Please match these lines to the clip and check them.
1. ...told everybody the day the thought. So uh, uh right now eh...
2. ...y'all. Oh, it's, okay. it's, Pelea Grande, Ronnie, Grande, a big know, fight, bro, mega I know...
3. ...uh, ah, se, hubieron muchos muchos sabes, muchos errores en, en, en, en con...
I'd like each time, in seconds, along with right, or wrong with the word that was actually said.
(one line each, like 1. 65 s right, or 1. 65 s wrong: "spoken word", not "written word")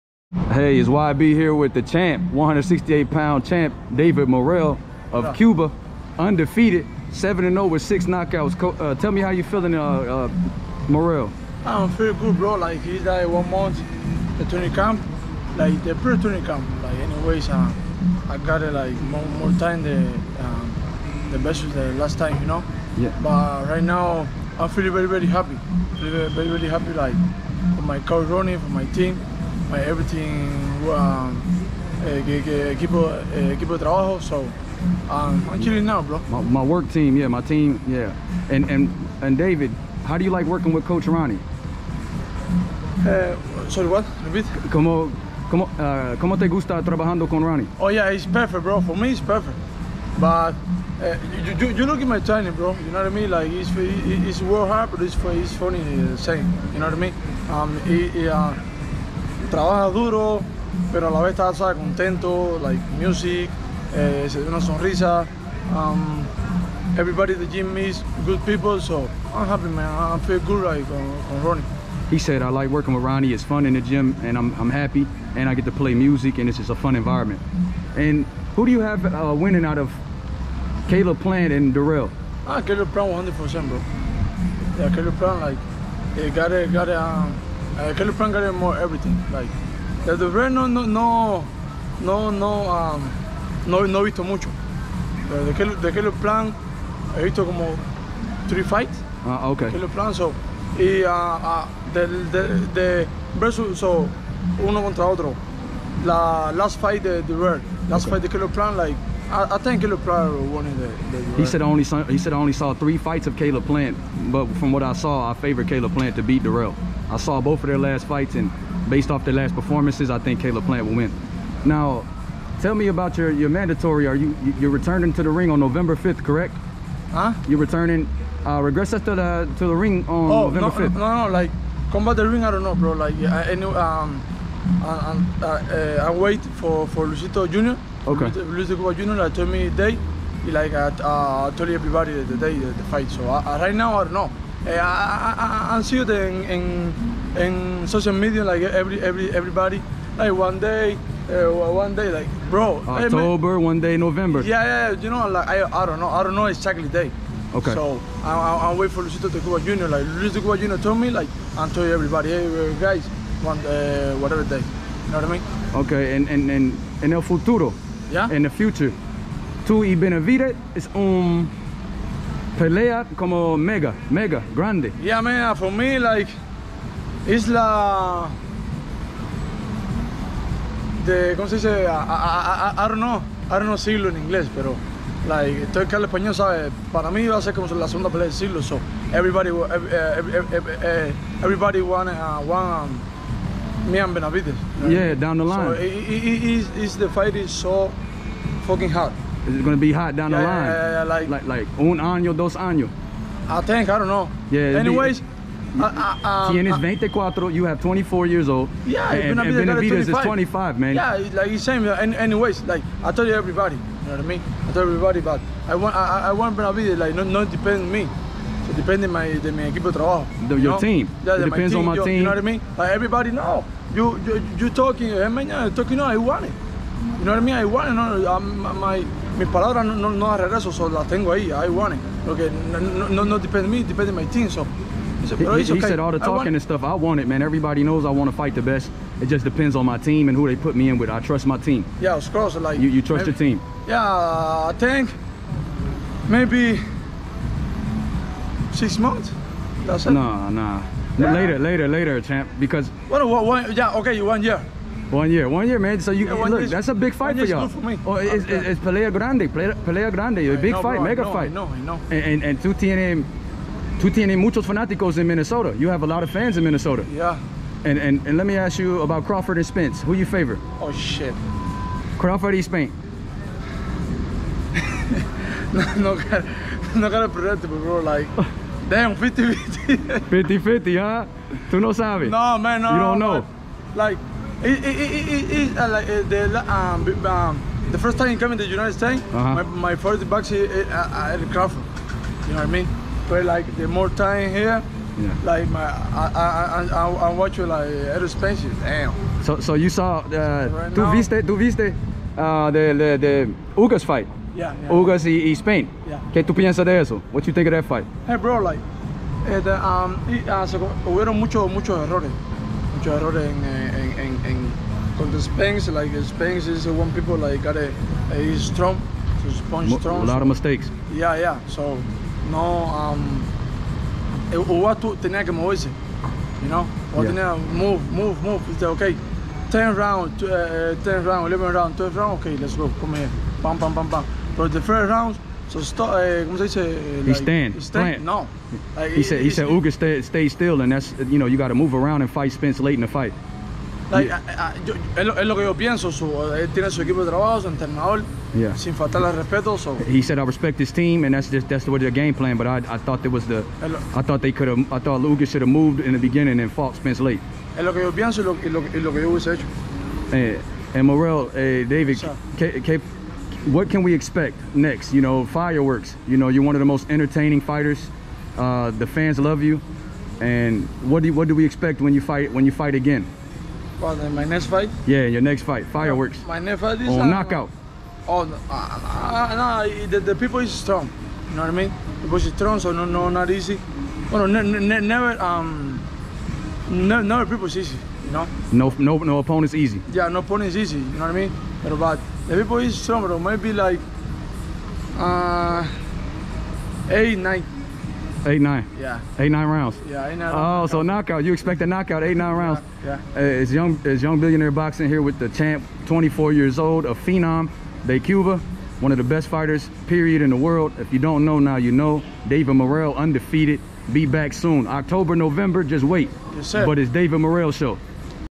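1. 141 s wrong: "fight", not "thought"
2. 257 s wrong: "Pelea", not "Ronnie"
3. 310 s wrong: "errores", not "sabes".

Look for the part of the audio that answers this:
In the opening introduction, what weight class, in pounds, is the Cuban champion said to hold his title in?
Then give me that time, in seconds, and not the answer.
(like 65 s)
2 s.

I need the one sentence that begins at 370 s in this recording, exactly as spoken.
And what do you, what do we expect when you fight when you fight again?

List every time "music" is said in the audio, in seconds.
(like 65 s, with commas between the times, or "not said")
62 s, 75 s.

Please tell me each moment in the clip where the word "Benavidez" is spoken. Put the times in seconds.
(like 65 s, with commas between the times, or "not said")
169 s, 194 s, 209 s, 216 s.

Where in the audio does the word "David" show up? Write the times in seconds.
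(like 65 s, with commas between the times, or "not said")
3 s, 39 s, 361 s, 412 s, 417 s.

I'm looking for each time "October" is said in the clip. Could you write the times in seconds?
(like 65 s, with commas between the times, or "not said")
152 s, 414 s.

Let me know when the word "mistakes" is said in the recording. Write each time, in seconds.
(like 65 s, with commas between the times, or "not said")
320 s.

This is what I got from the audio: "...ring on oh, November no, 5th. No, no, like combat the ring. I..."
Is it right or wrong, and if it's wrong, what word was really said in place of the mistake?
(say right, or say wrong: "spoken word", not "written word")
right.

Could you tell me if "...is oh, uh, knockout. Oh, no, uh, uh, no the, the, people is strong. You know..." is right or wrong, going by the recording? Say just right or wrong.
right.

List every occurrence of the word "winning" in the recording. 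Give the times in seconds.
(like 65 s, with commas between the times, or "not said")
79 s.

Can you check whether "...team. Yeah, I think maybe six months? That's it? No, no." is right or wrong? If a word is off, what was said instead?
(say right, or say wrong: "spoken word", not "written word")
right.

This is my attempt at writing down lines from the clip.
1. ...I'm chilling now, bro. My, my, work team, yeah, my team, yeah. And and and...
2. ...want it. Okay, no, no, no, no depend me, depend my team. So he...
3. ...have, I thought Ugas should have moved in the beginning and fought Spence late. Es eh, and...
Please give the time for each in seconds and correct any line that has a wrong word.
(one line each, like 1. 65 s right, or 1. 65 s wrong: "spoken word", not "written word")
1. 35 s right
2. 231 s right
3. 354 s right.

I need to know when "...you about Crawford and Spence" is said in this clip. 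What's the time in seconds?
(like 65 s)
268 s.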